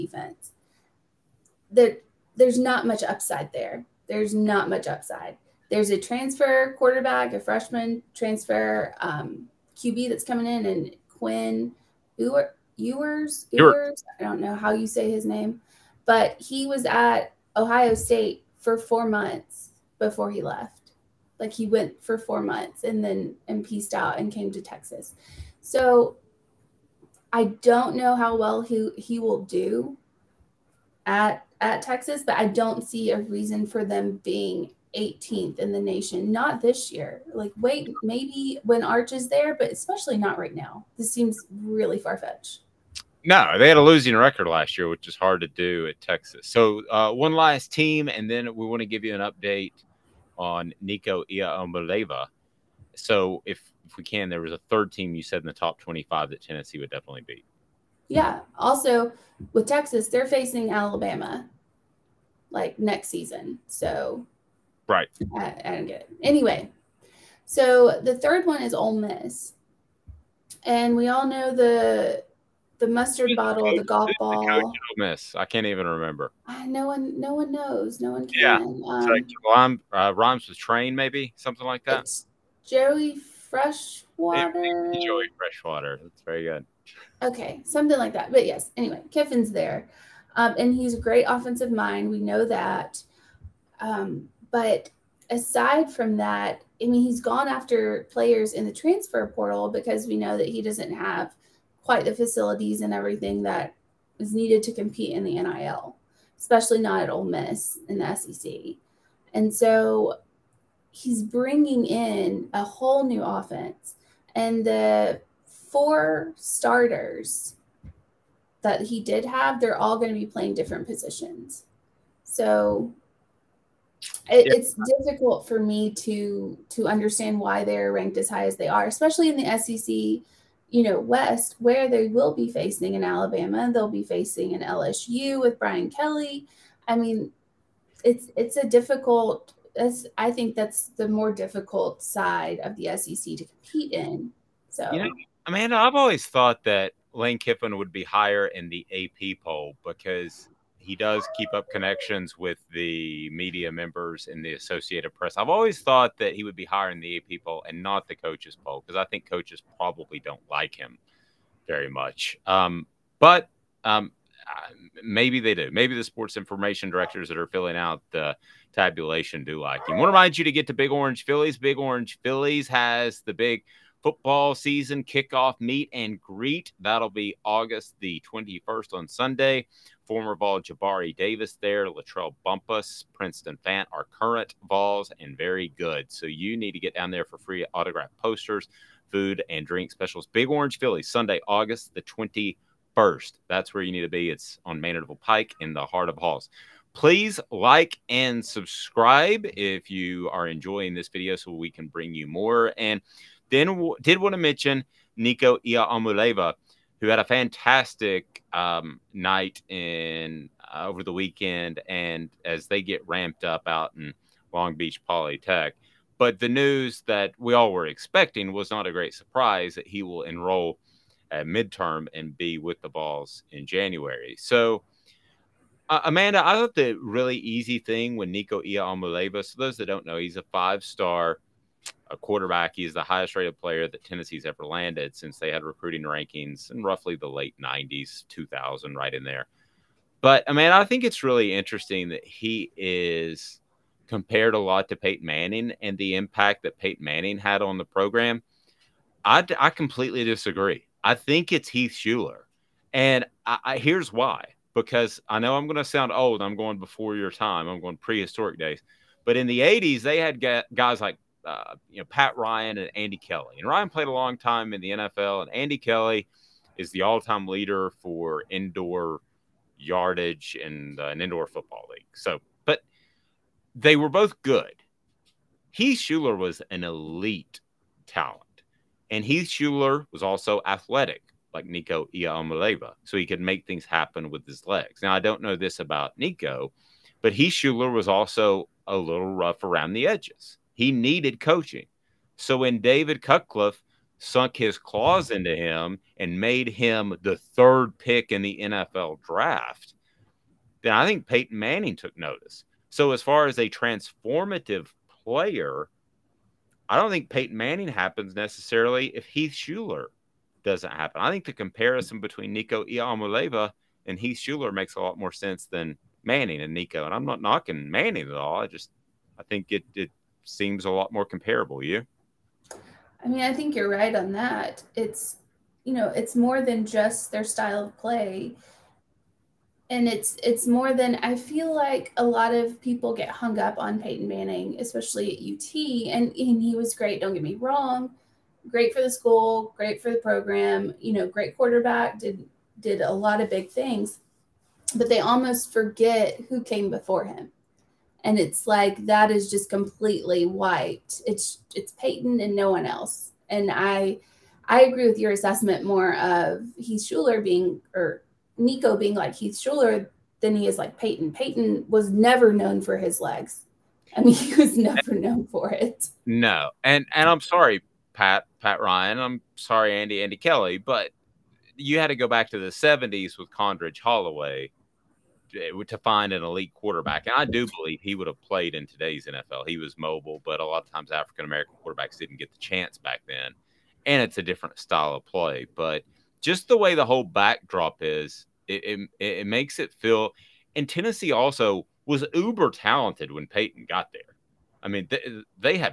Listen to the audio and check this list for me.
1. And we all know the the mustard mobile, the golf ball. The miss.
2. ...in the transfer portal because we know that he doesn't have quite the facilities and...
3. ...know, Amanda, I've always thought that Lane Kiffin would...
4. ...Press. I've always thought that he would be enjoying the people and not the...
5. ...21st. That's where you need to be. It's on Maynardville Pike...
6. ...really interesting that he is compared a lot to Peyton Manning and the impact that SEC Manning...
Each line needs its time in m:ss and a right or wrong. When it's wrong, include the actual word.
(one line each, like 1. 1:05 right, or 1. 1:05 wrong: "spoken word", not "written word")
1. 1:10 wrong: "bottle", not "mobile"
2. 1:38 right
3. 2:25 right
4. 2:35 wrong: "hiring", not "enjoying"
5. 3:12 right
6. 4:01 wrong: "Peyton", not "SEC".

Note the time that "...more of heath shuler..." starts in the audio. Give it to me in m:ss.
5:55.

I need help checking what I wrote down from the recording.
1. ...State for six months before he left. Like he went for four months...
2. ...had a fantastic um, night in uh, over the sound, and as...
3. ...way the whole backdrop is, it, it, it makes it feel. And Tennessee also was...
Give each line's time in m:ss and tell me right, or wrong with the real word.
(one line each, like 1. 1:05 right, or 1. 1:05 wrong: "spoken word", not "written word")
1. 0:17 wrong: "four", not "six"
2. 3:27 wrong: "weekend", not "sound"
3. 6:26 right.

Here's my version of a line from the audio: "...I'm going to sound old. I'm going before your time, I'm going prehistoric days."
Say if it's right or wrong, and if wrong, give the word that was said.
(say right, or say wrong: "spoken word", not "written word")
right.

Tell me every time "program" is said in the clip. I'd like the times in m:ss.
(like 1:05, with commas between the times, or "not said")
4:07, 5:40.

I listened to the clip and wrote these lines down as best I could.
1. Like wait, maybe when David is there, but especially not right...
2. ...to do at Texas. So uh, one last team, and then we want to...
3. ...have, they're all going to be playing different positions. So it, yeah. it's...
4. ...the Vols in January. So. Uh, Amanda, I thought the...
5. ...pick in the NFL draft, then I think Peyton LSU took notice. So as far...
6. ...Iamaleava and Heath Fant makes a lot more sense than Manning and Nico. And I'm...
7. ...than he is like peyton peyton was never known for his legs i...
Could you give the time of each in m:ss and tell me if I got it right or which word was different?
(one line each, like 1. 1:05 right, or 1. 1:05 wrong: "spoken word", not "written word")
1. 0:37 wrong: "Arch", not "David"
2. 0:45 right
3. 1:59 right
4. 3:42 right
5. 4:57 wrong: "Manning", not "LSU"
6. 5:12 wrong: "Shuler", not "Fant"
7. 6:00 right.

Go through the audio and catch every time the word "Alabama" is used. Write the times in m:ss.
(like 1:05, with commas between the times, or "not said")
1:00, 2:13.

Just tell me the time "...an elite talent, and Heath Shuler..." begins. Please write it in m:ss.
4:36.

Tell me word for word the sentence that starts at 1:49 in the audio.
And so he's bringing in a whole new offense.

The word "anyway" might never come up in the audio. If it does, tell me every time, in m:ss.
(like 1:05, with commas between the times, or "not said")
1:06, 1:28.